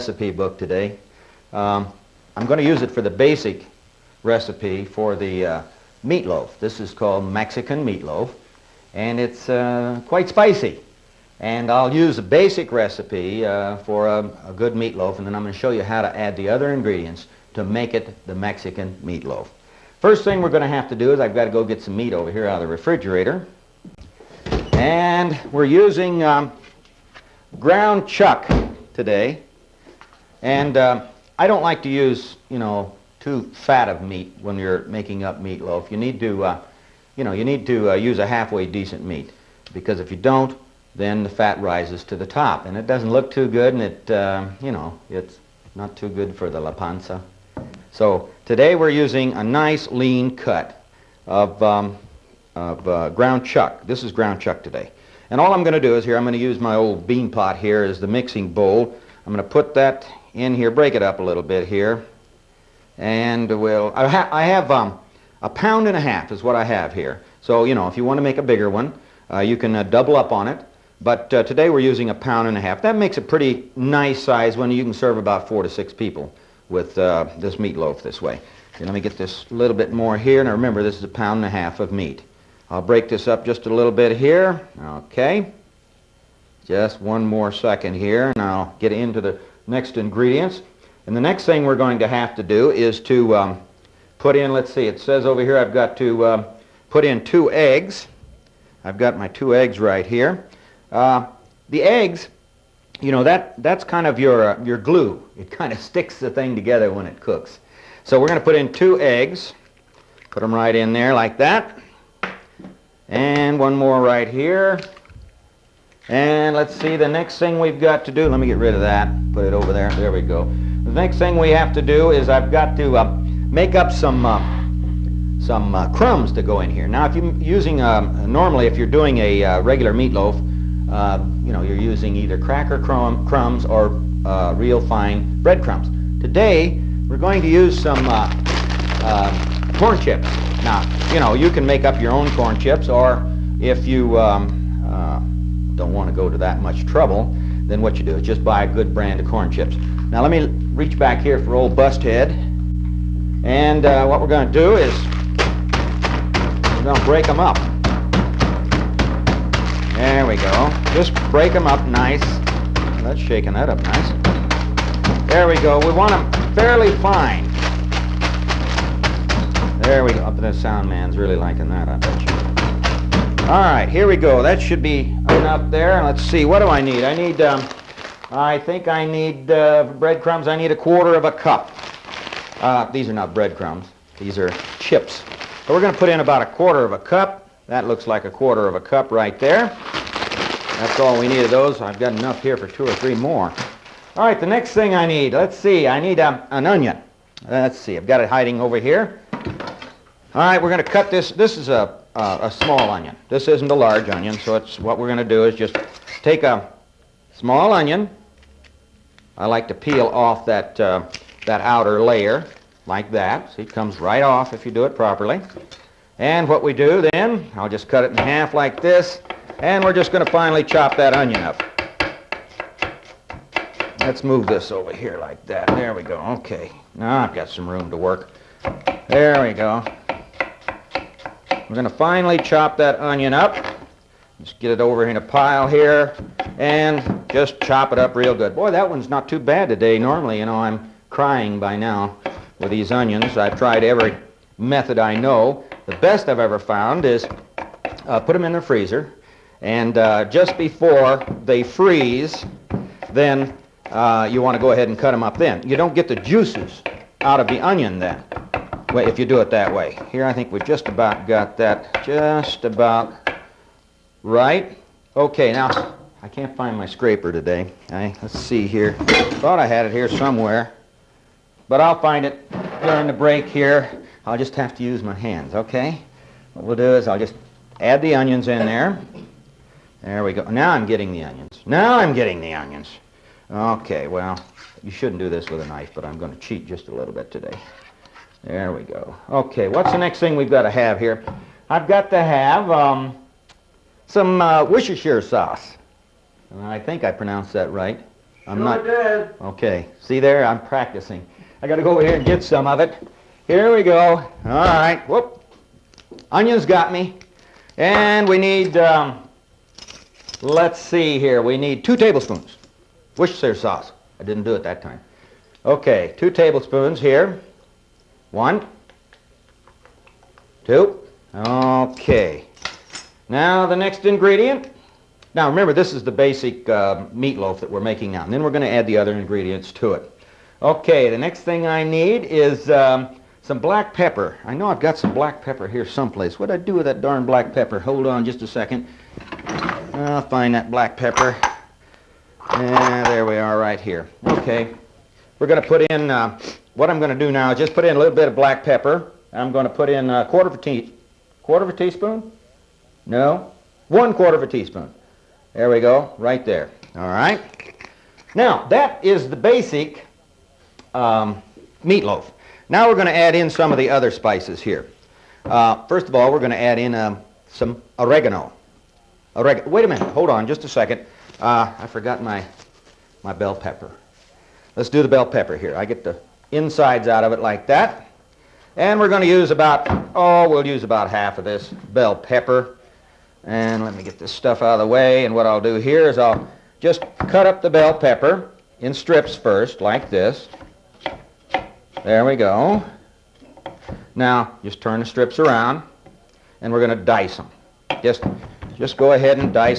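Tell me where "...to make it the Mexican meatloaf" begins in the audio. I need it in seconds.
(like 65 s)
17 s.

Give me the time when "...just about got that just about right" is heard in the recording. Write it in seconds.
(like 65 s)
260 s.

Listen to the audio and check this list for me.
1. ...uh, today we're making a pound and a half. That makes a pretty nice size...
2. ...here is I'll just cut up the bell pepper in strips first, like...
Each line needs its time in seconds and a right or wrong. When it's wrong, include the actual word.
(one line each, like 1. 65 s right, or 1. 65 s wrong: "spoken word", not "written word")
1. 71 s wrong: "using", not "making"
2. 385 s right.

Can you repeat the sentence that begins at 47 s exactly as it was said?
So today we're using a nice lean cut of, um, of uh, ground chuck.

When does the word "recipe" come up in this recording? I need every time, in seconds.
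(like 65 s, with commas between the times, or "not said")
4 s, 12 s.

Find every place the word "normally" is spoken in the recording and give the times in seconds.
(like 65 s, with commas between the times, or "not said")
128 s, 239 s.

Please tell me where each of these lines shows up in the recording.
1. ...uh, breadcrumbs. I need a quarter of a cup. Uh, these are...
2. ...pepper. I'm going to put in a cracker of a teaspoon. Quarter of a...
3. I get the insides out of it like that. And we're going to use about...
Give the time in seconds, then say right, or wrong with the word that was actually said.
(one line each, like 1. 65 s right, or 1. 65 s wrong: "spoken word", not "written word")
1. 179 s right
2. 348 s wrong: "quarter", not "cracker"
3. 375 s right.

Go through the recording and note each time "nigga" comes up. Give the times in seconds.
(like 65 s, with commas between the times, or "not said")
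not said.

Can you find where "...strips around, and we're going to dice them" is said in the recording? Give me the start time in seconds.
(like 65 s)
395 s.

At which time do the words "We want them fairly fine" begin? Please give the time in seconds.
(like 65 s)
165 s.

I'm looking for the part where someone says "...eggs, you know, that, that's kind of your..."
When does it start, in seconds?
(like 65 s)
101 s.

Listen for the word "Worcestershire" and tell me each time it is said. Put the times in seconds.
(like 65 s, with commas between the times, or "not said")
294 s, 313 s.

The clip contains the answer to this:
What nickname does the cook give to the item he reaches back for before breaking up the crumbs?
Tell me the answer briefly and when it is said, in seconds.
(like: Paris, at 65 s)
Busthead, at 151 s.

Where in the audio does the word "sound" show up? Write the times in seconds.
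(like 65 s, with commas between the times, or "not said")
170 s.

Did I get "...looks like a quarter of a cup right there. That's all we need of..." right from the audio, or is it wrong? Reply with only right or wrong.
right.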